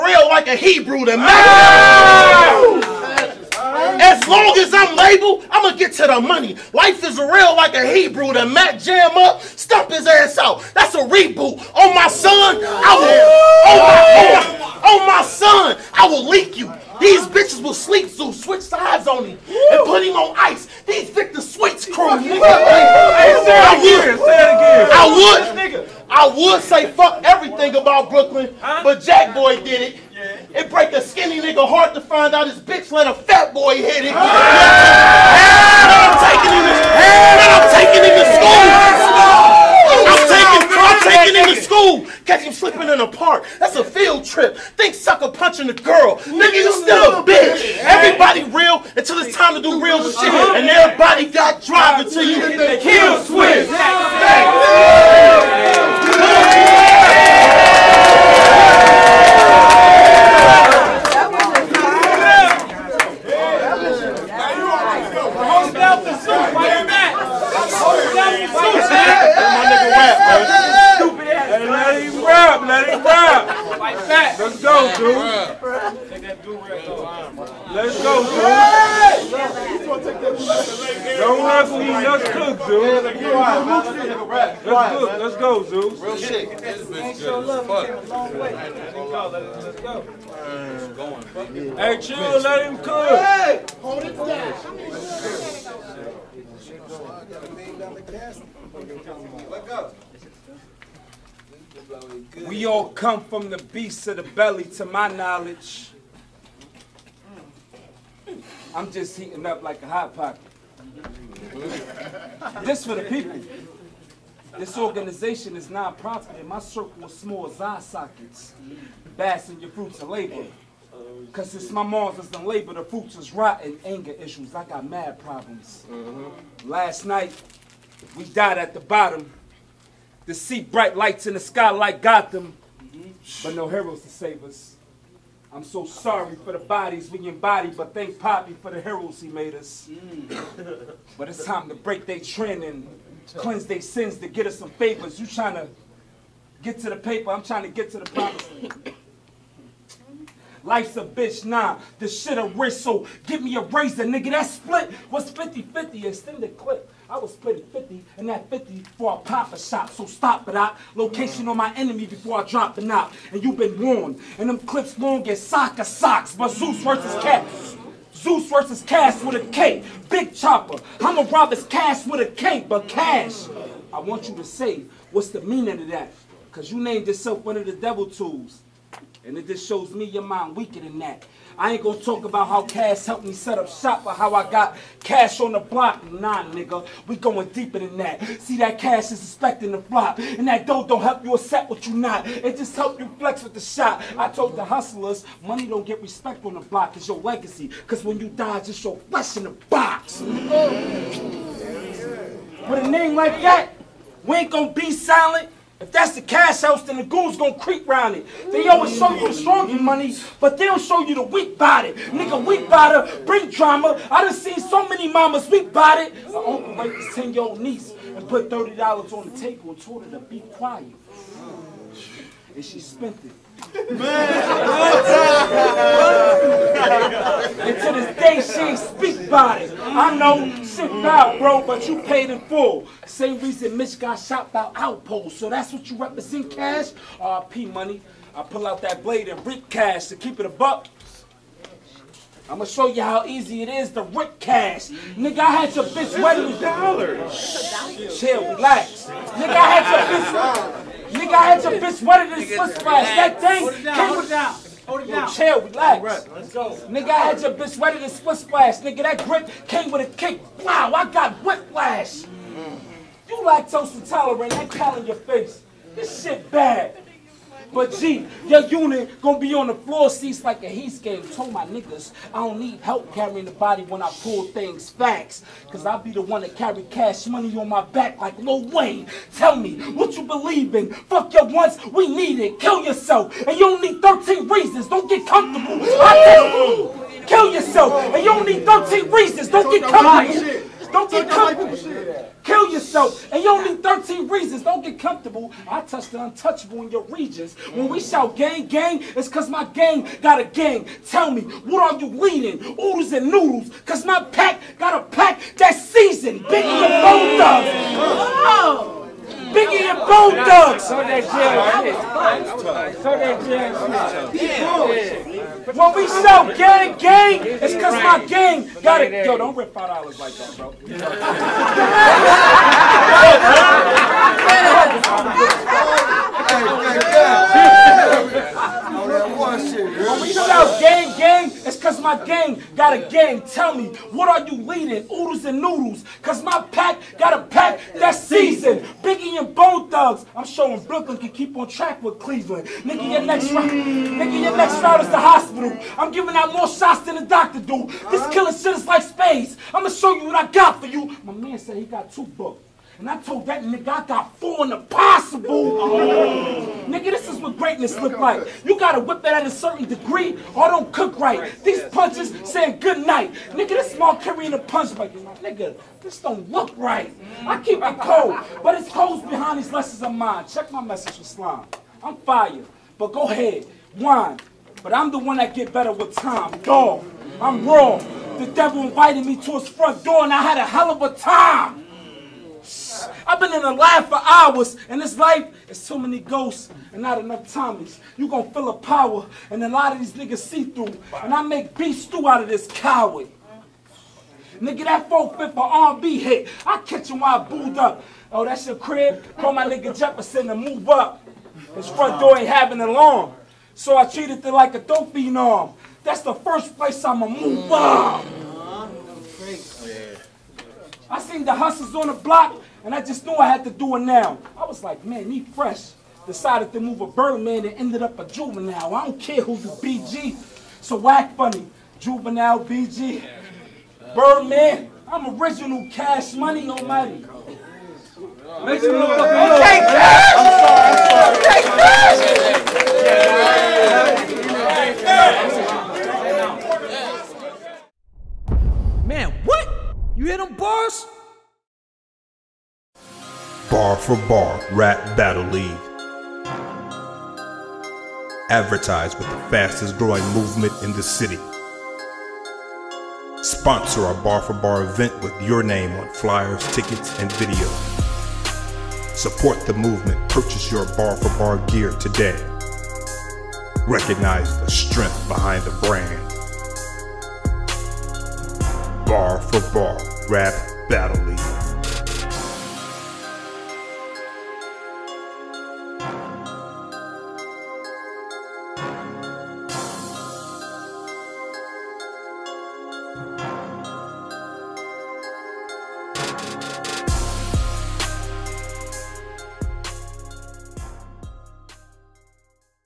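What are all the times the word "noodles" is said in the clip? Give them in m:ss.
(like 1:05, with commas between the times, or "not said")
5:03, 5:35.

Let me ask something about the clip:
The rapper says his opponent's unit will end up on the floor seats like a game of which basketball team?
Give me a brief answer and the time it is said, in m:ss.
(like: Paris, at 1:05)
Heat, at 4:30.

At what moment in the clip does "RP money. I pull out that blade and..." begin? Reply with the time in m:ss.
3:57.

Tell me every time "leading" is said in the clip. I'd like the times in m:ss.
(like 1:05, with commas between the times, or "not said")
5:02, 5:34.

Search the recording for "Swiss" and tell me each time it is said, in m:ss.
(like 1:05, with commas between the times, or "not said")
4:12, 4:18.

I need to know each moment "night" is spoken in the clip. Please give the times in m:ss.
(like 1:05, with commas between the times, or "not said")
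2:07, 6:03.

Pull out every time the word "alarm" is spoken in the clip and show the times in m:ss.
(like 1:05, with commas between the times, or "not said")
6:42.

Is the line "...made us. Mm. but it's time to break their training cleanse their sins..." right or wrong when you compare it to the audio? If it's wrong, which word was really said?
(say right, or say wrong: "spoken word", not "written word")
right.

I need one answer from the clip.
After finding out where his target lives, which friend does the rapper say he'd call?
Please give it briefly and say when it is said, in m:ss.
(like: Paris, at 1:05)
Jefferson, at 6:39.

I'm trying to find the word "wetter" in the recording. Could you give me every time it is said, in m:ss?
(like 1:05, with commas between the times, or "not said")
4:12, 4:17.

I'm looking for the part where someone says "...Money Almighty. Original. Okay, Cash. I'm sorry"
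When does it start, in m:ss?
7:06.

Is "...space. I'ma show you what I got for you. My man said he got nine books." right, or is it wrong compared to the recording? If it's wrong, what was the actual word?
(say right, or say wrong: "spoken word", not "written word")
wrong: "two", not "nine".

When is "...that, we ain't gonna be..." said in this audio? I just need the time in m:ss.
3:23.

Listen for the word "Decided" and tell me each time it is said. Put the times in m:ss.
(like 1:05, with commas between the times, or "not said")
6:56.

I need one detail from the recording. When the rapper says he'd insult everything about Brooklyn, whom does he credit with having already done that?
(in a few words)
Jack Boy.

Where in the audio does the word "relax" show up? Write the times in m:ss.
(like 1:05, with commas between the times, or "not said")
4:08, 4:15.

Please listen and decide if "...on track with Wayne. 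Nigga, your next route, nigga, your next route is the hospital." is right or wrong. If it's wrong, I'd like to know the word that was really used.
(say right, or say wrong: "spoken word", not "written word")
wrong: "Cleveland", not "Wayne".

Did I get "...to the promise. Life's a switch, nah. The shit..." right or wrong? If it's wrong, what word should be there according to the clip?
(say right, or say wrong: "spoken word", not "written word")
wrong: "bitch", not "switch".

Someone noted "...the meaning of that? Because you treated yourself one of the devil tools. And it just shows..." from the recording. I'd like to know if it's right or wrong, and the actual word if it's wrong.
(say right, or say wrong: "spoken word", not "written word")
wrong: "named", not "treated".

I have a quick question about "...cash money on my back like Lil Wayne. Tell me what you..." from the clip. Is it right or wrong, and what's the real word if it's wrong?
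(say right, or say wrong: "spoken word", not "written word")
right.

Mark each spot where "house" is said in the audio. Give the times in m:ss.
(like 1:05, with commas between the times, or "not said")
3:26.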